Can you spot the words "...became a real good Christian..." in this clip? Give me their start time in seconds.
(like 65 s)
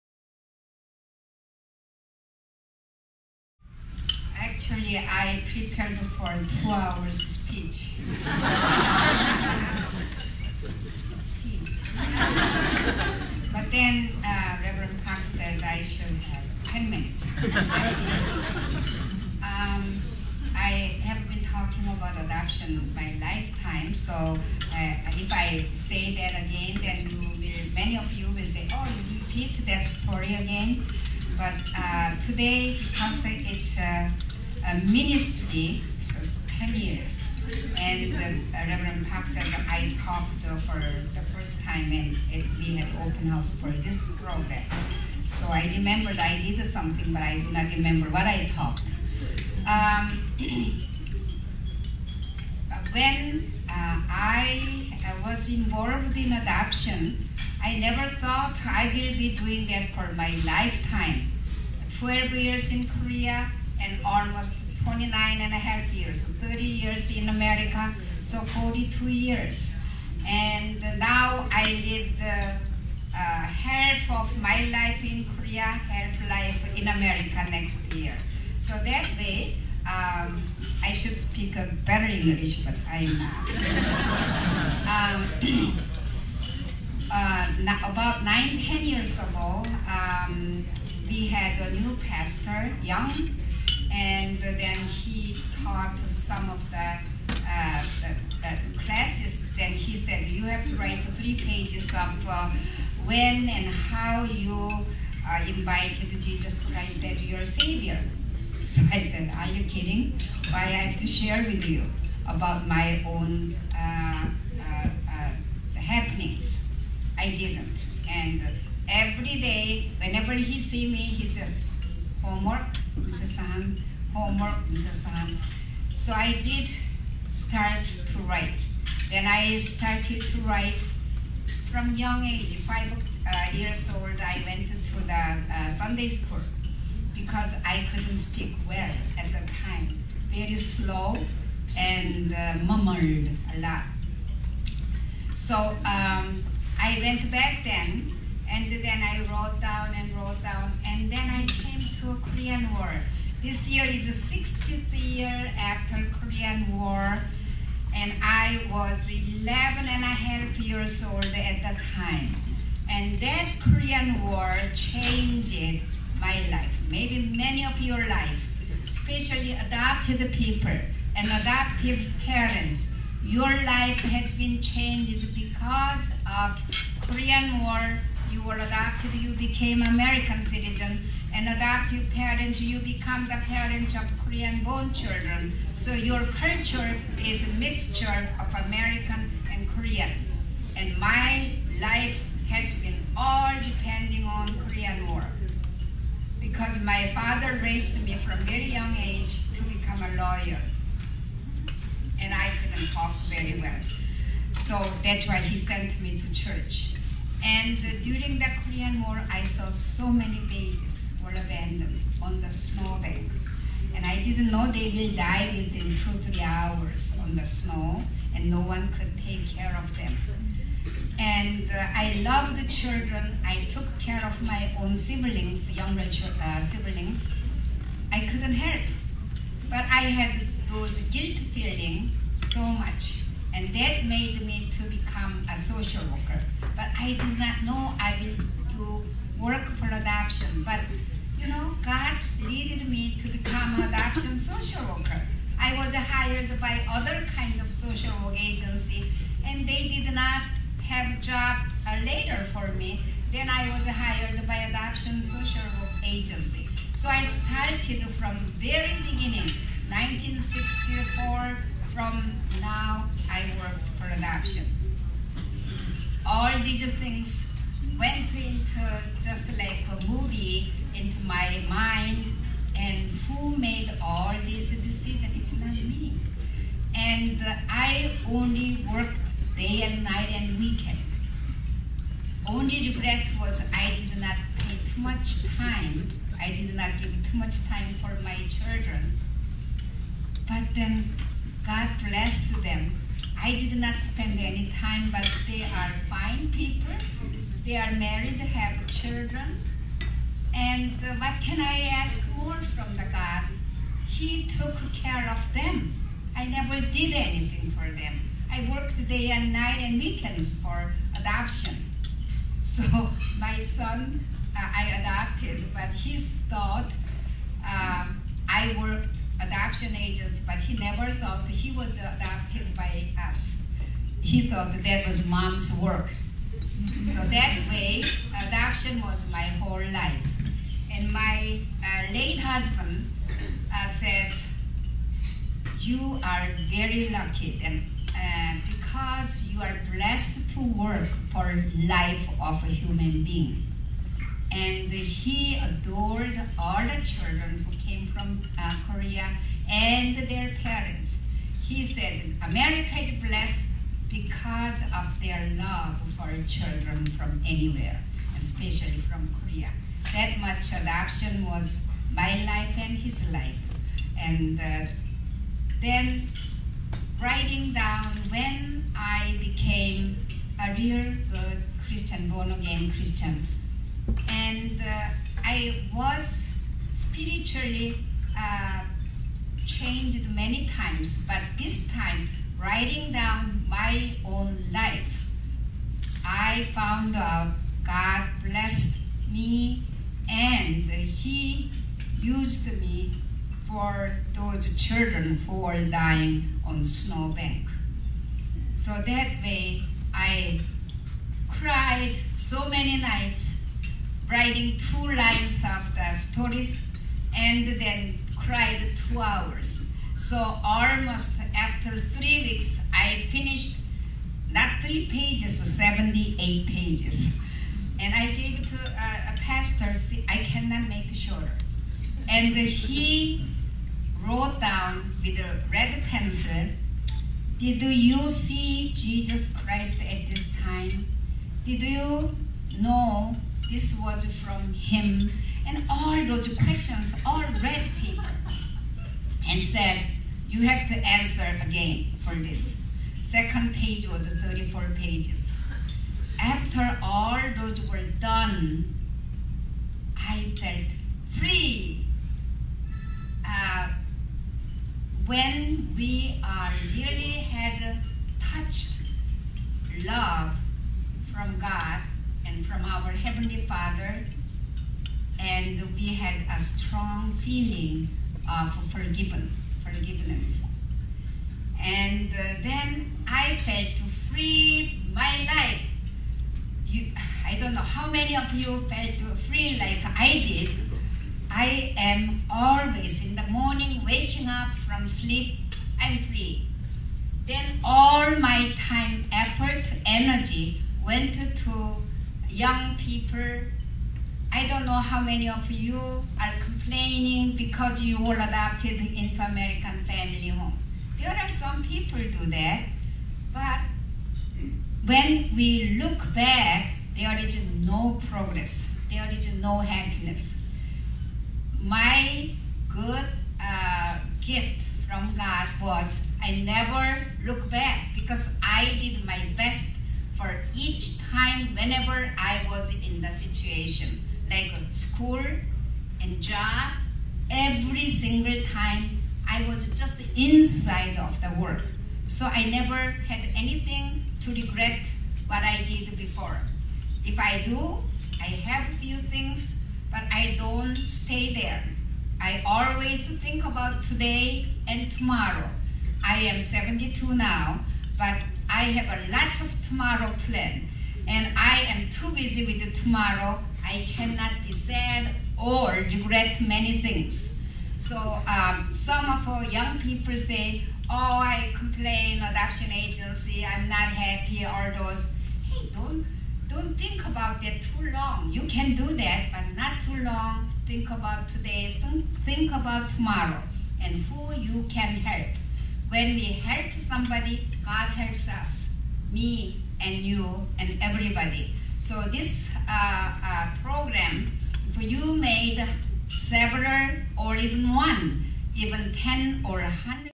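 369 s.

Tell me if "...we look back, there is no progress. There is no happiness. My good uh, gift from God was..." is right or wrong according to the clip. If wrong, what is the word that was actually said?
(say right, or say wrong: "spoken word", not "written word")
right.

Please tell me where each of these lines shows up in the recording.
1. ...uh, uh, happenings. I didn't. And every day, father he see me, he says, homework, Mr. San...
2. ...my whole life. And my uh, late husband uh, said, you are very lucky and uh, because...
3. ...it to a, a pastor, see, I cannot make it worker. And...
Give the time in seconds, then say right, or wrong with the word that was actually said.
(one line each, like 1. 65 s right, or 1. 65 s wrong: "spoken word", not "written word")
1. 114 s wrong: "whenever", not "father"
2. 329 s right
3. 418 s wrong: "shorter", not "worker".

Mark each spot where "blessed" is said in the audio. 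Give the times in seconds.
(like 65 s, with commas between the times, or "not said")
292 s, 339 s, 353 s, 388 s.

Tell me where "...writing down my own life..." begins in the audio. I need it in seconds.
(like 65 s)
382 s.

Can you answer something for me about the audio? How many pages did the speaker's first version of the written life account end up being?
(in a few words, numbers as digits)
78 pages.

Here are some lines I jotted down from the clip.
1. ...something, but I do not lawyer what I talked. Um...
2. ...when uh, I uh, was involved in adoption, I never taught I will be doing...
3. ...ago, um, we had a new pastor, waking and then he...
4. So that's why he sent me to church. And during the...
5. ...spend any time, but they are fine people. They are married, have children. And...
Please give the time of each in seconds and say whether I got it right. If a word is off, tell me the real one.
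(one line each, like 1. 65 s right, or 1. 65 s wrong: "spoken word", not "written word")
1. 46 s wrong: "remember", not "lawyer"
2. 52 s wrong: "thought", not "taught"
3. 89 s wrong: "young", not "waking"
4. 204 s right
5. 293 s right.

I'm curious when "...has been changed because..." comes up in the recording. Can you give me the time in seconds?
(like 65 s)
174 s.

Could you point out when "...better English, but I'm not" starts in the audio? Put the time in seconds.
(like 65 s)
81 s.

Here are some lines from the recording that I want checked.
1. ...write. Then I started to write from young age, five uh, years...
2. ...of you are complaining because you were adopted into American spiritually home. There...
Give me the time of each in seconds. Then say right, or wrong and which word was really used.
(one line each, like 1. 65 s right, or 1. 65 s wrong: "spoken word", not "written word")
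1. 128 s right
2. 495 s wrong: "family", not "spiritually".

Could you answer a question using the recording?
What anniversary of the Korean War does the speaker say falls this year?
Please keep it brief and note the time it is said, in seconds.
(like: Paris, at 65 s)
60th, at 154 s.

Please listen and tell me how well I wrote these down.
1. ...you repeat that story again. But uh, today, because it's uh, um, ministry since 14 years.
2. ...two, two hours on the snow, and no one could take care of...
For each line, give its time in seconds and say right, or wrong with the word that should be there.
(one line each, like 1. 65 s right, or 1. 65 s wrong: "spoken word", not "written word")
1. 29 s wrong: "10", not "14"
2. 215 s wrong: "three", not "two".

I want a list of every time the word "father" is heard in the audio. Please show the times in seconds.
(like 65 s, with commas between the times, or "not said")
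197 s, 463 s.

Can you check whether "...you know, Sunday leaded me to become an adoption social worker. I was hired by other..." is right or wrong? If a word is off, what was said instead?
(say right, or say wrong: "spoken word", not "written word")
wrong: "God", not "Sunday".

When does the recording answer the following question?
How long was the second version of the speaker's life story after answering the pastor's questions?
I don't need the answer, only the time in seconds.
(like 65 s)
444 s.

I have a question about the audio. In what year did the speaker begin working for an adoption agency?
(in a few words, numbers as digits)
1964.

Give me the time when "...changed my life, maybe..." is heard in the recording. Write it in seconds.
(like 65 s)
164 s.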